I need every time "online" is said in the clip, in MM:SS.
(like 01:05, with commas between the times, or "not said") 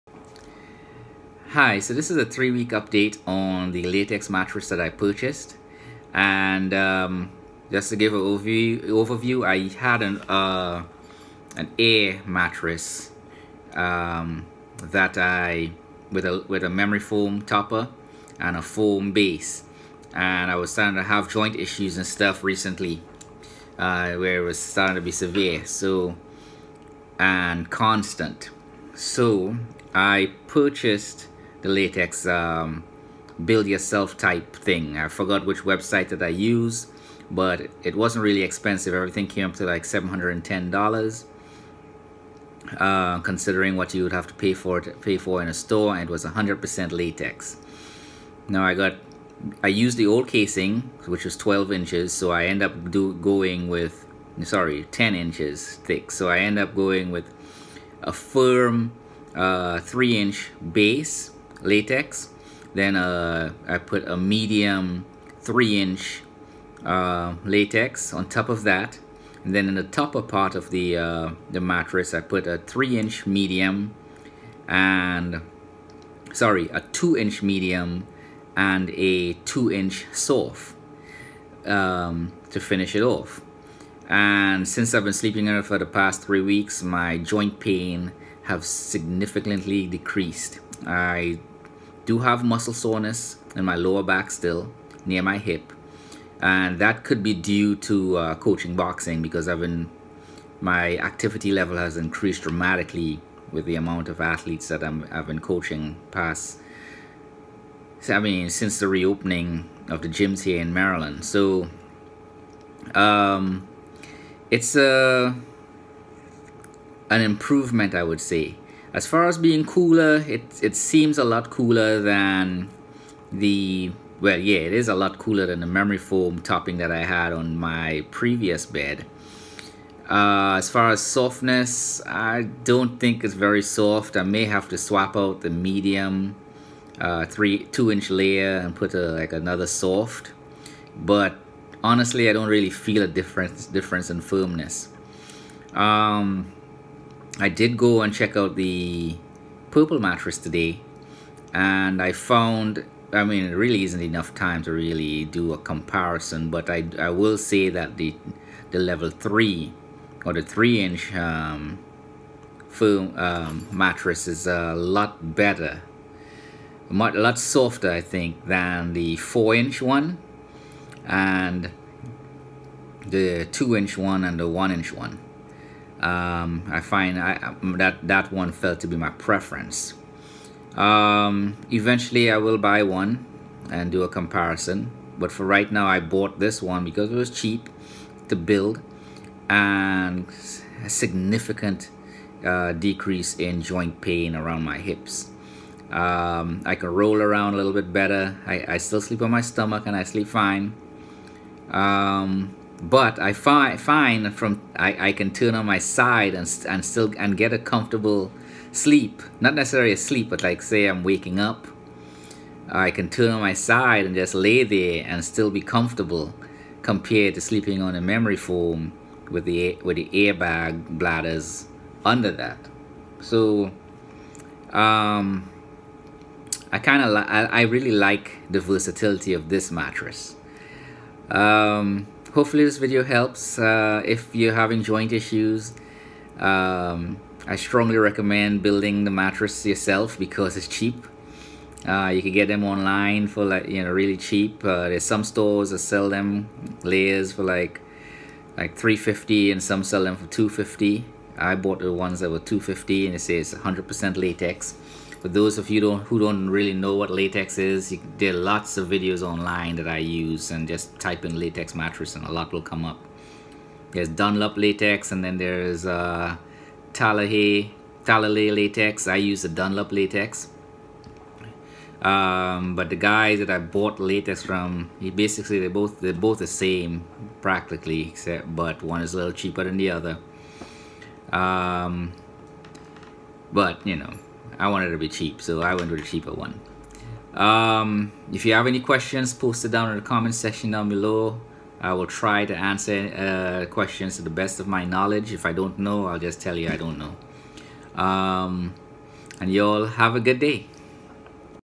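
04:02, 04:19.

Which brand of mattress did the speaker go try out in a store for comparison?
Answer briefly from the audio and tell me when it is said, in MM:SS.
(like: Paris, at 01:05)
Purple, at 02:29.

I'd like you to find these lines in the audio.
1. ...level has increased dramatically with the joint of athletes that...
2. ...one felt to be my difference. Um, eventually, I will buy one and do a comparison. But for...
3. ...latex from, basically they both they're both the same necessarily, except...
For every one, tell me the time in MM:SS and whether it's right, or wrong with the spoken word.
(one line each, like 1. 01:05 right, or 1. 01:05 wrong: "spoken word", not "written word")
1. 01:41 wrong: "amount", not "joint"
2. 02:58 wrong: "preference", not "difference"
3. 04:33 wrong: "practically", not "necessarily".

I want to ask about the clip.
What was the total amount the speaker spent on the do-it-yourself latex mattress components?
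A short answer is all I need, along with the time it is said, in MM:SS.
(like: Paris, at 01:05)
$710, at 00:39.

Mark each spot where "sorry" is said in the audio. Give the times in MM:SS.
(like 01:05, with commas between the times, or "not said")
00:54, 01:16.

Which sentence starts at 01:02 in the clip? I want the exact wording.
Then uh, I put a medium three inch uh, latex on top of that.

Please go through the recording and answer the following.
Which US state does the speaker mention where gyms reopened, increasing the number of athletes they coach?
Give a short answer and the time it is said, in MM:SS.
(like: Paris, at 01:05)
Maryland, at 01:50.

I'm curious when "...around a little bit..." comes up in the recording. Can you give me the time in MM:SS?
03:17.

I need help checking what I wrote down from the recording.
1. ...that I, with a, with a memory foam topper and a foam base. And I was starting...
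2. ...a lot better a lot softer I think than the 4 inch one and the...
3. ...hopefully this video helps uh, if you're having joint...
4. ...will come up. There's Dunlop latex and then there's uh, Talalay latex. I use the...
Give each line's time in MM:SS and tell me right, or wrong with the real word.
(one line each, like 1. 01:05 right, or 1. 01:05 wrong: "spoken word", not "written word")
1. 00:14 right
2. 02:44 right
3. 03:52 right
4. 04:22 right.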